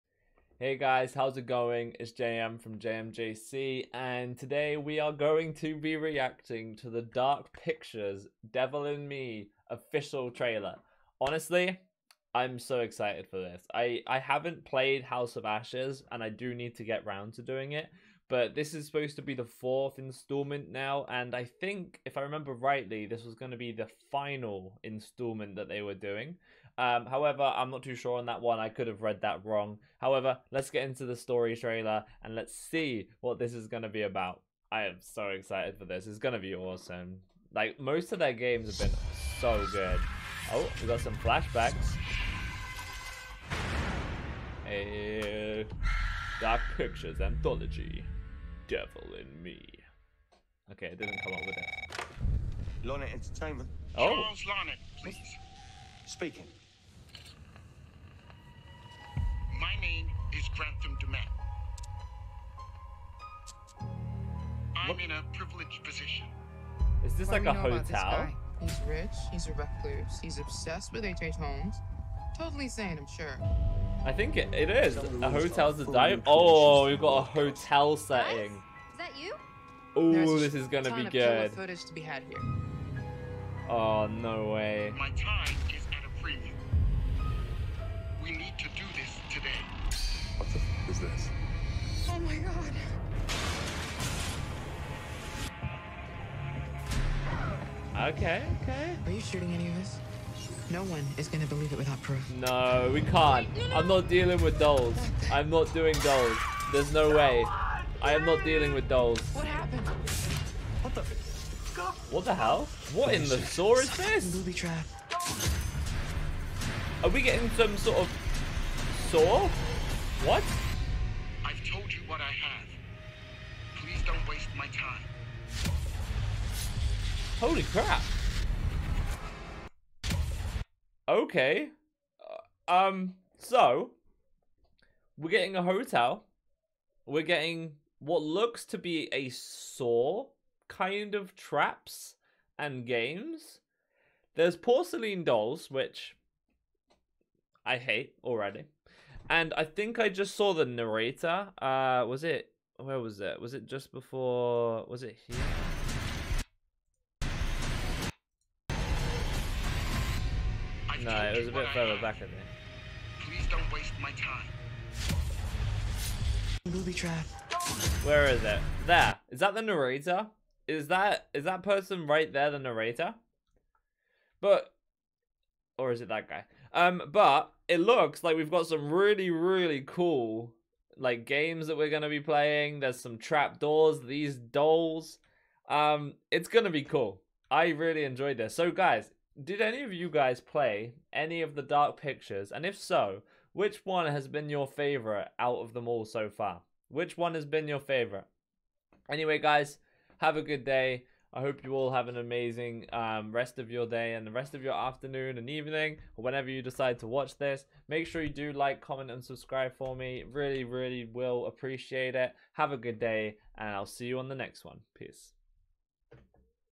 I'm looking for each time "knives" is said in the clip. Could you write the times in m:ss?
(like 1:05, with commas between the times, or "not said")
not said.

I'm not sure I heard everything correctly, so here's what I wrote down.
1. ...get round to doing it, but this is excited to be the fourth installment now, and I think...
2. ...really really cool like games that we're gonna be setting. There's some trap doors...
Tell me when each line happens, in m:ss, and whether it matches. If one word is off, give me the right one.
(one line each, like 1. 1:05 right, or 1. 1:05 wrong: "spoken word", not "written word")
1. 0:16 wrong: "supposed", not "excited"
2. 2:58 wrong: "playing", not "setting".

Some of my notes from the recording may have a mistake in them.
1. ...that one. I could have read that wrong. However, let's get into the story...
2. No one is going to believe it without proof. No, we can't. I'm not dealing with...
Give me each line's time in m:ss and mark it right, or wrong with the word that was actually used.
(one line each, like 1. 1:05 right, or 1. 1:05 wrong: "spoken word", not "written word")
1. 0:28 right
2. 1:40 right.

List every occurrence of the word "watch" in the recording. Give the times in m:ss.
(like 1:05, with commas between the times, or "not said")
3:27.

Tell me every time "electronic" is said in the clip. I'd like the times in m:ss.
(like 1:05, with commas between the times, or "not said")
not said.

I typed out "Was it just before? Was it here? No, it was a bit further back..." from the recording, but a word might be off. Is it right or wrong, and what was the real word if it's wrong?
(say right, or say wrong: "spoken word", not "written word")
right.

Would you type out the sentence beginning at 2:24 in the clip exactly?
There's porcelain dolls, which I hate already.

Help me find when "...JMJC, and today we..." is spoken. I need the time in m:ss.
0:02.